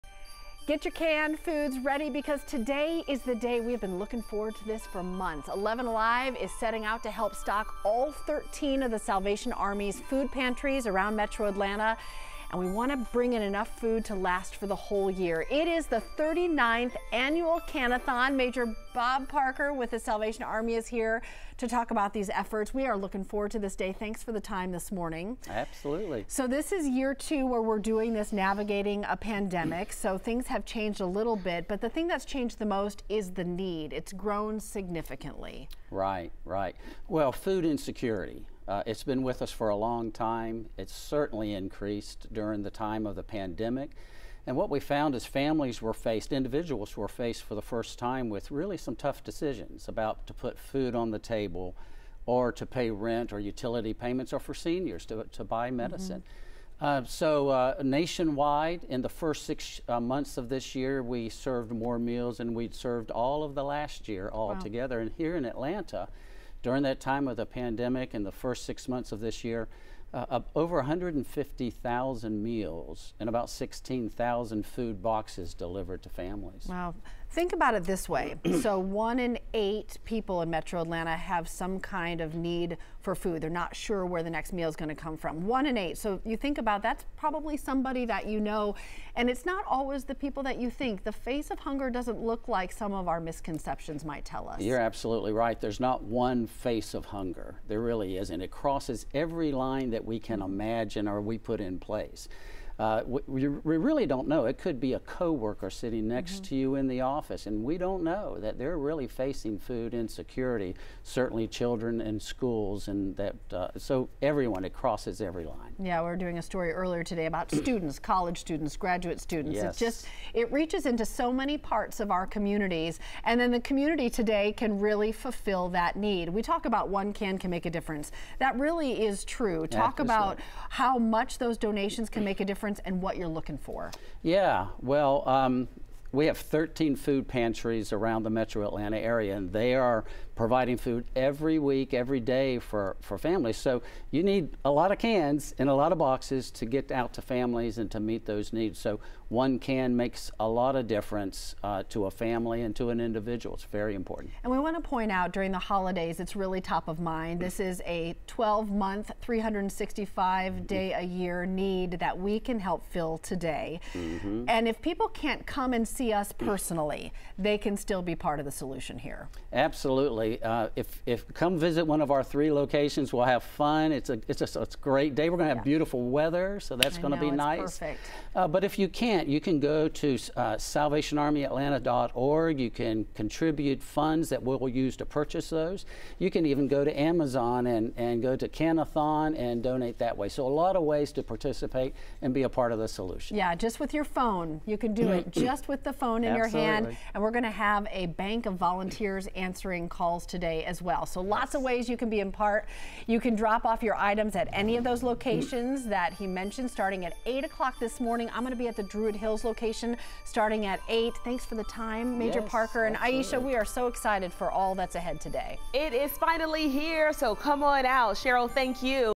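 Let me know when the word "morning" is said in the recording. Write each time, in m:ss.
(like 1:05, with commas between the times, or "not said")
0:24, 3:27.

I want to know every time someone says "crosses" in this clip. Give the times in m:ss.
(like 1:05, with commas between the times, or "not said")
1:38, 1:54.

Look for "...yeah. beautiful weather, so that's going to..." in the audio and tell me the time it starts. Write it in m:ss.
2:55.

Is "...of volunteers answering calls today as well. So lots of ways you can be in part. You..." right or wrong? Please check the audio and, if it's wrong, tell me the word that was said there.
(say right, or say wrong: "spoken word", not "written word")
right.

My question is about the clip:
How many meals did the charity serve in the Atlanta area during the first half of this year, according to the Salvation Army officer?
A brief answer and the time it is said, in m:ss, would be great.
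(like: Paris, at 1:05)
150,000, at 1:10.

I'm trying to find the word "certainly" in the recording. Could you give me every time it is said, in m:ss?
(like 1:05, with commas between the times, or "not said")
0:40, 1:51.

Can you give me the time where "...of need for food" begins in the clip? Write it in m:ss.
1:22.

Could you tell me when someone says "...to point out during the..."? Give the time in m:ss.
2:34.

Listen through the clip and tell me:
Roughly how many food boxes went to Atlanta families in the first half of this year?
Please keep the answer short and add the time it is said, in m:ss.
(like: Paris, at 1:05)
16,000, at 1:13.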